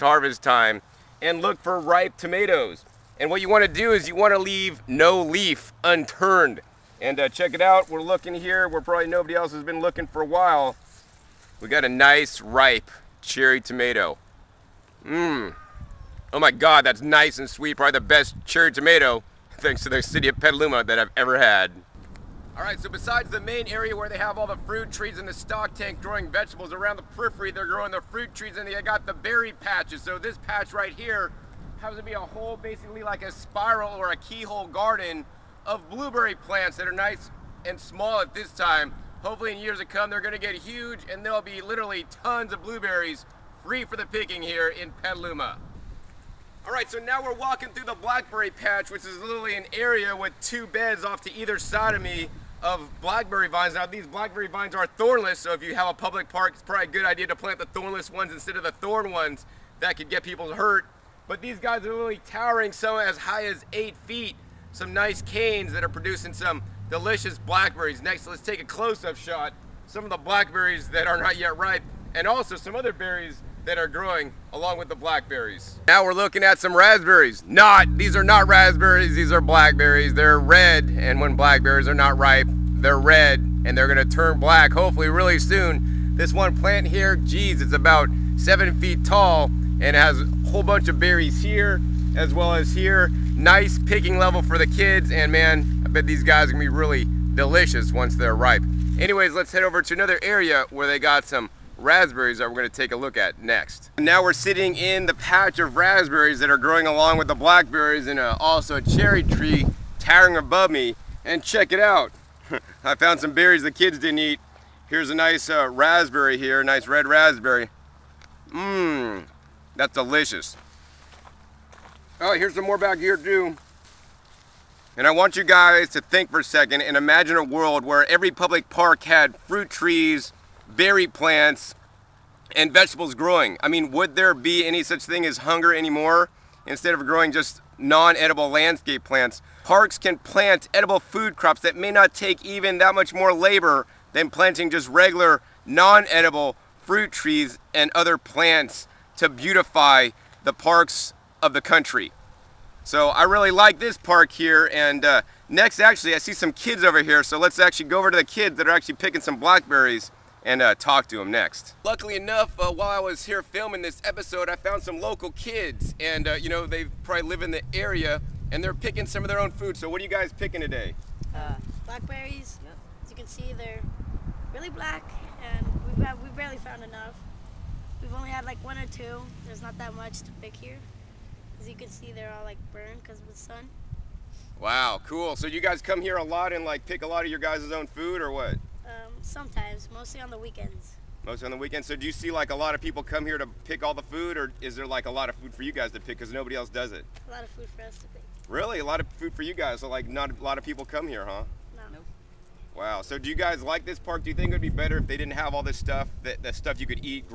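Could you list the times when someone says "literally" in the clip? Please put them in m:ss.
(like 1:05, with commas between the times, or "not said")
0:41, 0:49, 1:01.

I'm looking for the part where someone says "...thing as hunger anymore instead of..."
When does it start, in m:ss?
2:15.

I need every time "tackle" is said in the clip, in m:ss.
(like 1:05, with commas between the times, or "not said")
not said.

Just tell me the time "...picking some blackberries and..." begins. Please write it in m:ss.
2:38.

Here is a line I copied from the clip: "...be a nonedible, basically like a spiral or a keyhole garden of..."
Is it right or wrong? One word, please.
wrong.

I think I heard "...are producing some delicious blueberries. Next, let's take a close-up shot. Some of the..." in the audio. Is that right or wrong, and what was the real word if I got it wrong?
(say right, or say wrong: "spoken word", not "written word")
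wrong: "blackberries", not "blueberries".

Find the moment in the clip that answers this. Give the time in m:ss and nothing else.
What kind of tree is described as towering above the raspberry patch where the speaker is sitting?
1:48.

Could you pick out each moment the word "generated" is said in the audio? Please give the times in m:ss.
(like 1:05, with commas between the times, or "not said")
not said.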